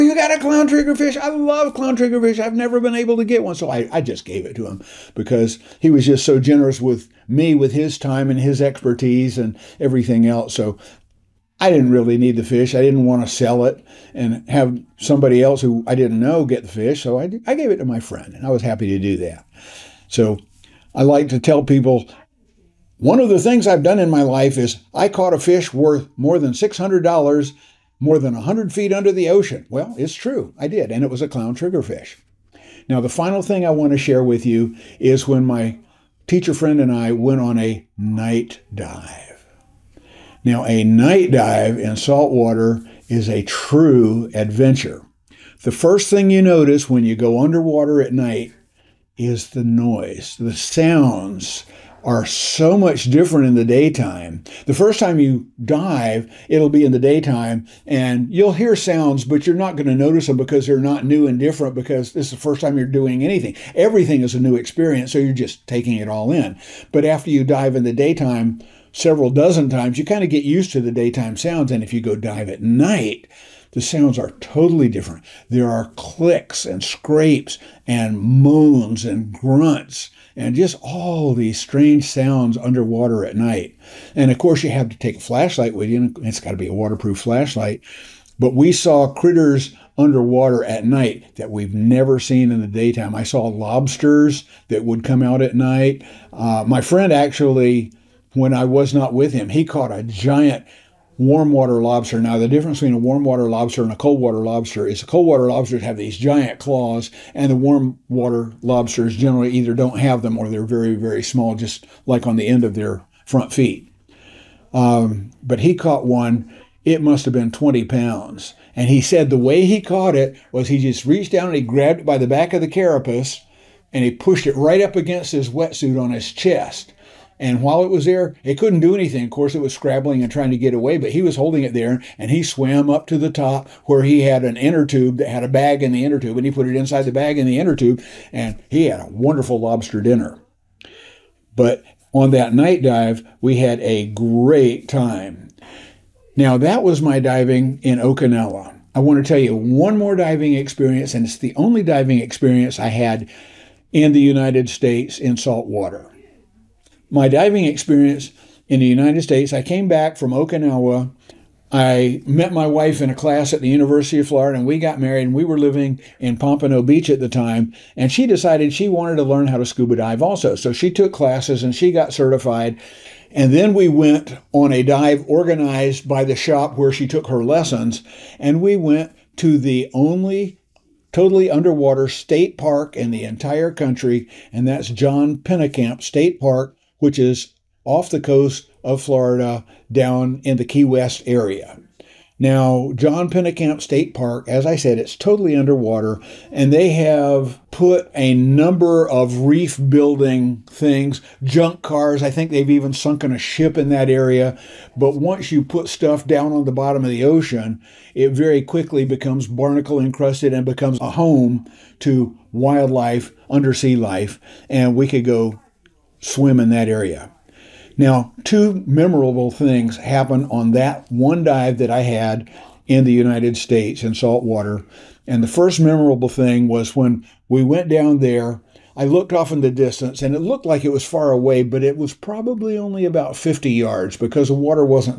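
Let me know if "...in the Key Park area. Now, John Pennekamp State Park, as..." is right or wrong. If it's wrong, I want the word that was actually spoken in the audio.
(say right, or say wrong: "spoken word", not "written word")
wrong: "West", not "Park".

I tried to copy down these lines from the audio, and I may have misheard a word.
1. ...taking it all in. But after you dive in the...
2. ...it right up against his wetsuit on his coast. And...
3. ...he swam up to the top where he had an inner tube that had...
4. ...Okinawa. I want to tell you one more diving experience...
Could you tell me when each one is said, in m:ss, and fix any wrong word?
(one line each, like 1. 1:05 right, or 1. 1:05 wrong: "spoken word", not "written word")
1. 1:05 right
2. 2:04 wrong: "chest", not "coast"
3. 2:12 right
4. 2:27 right.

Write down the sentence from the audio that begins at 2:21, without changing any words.
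But on that night dive, we had a great time.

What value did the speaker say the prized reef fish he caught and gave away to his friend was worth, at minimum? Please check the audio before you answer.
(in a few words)
$600.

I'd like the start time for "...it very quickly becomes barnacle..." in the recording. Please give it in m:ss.
3:28.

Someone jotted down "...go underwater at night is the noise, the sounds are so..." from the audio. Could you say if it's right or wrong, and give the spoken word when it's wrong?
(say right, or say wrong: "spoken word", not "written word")
right.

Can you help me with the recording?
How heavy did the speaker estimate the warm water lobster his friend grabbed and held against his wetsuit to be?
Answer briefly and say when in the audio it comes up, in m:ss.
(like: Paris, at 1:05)
20 pounds, at 1:57.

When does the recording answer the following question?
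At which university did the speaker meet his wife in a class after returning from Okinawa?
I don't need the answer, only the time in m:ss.
2:43.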